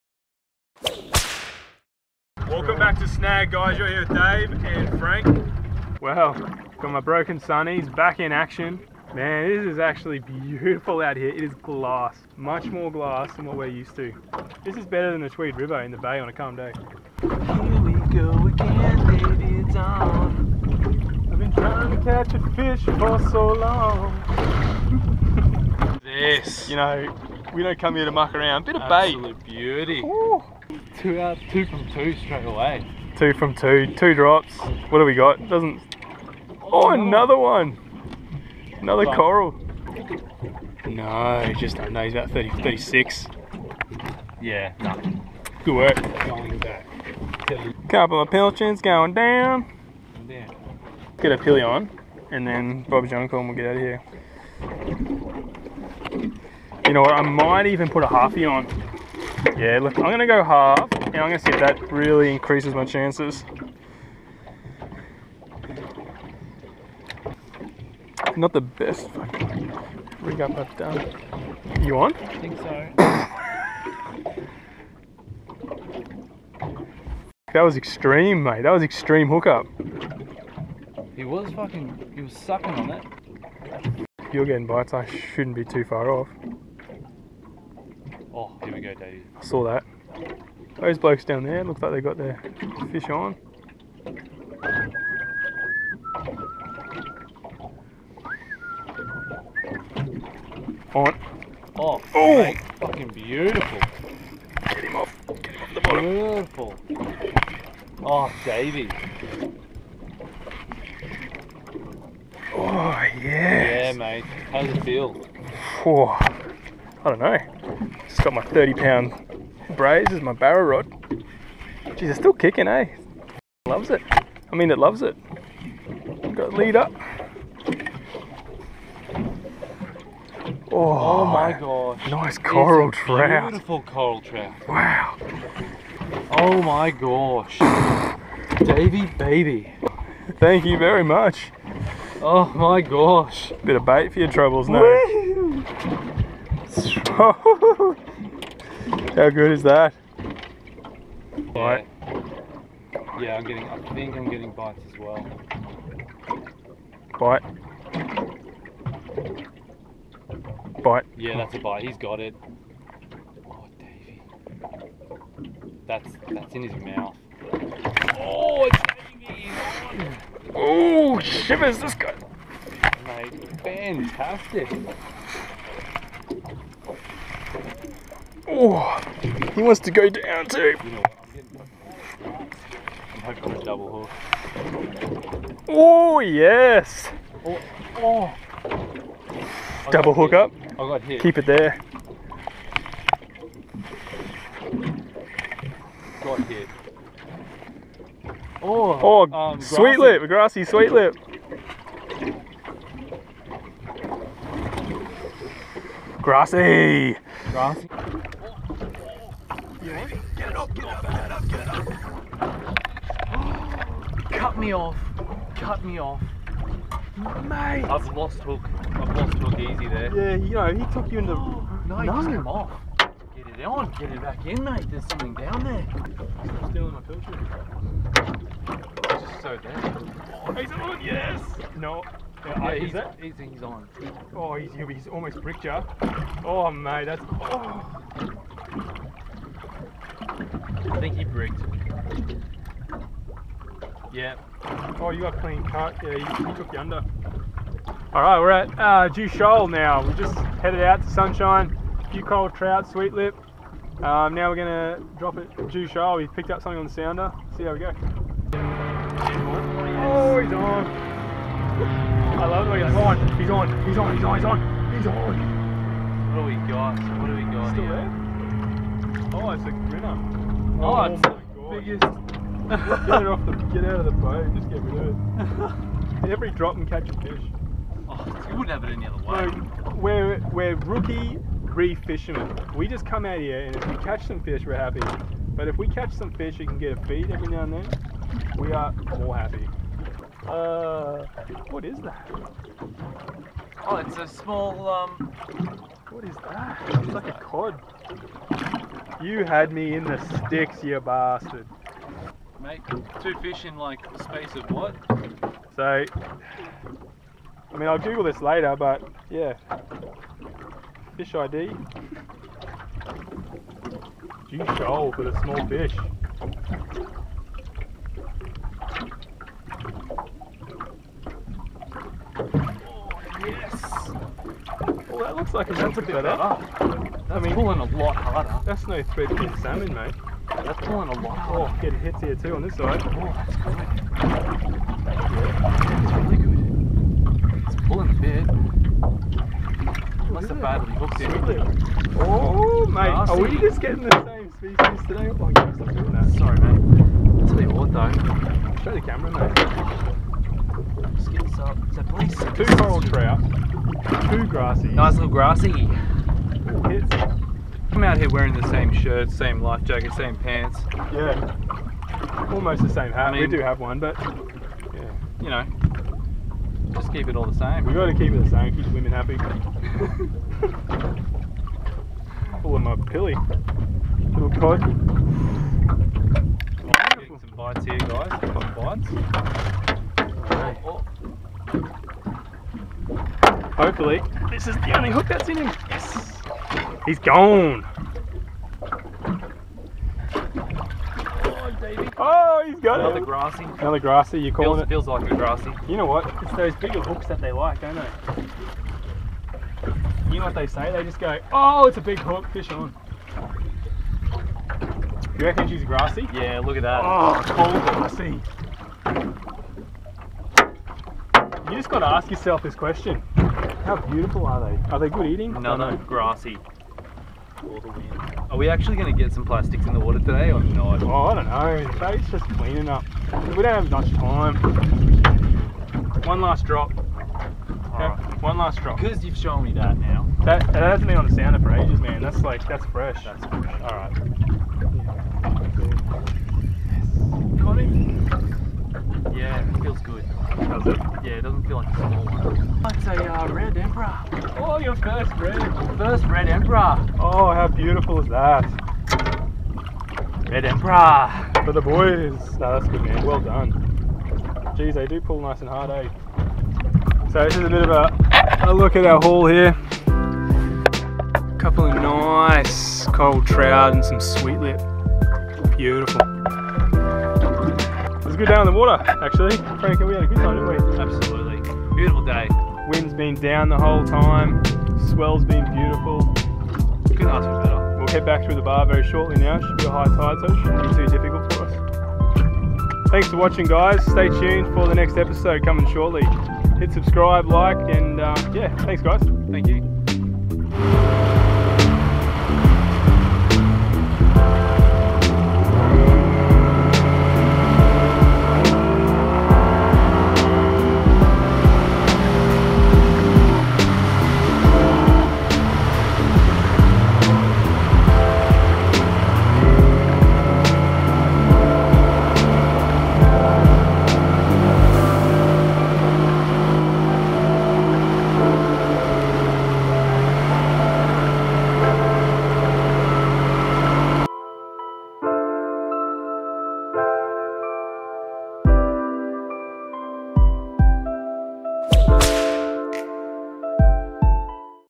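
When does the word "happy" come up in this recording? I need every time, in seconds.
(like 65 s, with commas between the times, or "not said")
284 s, 289 s, 369 s.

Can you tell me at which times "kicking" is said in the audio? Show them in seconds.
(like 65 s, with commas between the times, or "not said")
122 s.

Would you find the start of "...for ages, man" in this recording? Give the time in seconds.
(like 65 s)
431 s.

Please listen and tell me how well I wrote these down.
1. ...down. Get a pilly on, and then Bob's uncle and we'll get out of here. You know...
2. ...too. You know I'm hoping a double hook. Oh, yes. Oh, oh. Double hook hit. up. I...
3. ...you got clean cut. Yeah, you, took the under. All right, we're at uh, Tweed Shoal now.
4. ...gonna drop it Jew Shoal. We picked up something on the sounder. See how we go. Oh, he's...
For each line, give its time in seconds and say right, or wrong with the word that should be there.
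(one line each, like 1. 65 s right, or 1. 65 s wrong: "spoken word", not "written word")
1. 49 s right
2. 180 s right
3. 245 s wrong: "Jew", not "Tweed"
4. 254 s right.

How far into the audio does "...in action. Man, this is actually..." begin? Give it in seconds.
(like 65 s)
8 s.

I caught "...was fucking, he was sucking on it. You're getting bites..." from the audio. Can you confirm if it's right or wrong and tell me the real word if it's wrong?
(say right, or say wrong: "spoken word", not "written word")
right.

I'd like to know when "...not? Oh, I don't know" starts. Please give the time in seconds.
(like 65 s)
420 s.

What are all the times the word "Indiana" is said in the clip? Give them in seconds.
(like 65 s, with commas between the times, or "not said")
not said.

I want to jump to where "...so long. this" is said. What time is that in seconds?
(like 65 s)
23 s.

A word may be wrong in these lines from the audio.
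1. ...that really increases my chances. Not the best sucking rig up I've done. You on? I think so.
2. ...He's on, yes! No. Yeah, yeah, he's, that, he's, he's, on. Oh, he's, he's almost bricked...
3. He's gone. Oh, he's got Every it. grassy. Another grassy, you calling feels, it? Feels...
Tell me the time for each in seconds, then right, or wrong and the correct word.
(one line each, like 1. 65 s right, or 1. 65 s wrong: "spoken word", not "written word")
1. 61 s wrong: "fucking", not "sucking"
2. 230 s right
3. 387 s wrong: "Another", not "Every".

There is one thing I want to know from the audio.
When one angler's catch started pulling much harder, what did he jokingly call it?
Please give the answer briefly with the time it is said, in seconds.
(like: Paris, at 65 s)
threadfin salmon, at 329 s.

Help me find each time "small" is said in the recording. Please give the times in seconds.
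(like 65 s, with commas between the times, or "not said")
294 s, 315 s, 441 s.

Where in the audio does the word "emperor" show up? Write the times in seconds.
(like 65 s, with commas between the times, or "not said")
446 s, 450 s.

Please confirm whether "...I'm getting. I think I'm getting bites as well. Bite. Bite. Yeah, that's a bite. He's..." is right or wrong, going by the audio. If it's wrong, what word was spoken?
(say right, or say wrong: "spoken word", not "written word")
right.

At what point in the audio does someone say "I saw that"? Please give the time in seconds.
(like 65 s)
89 s.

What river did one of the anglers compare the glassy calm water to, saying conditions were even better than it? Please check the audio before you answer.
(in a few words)
Tweed River.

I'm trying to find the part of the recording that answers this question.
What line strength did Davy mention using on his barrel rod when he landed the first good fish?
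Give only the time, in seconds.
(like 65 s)
118 s.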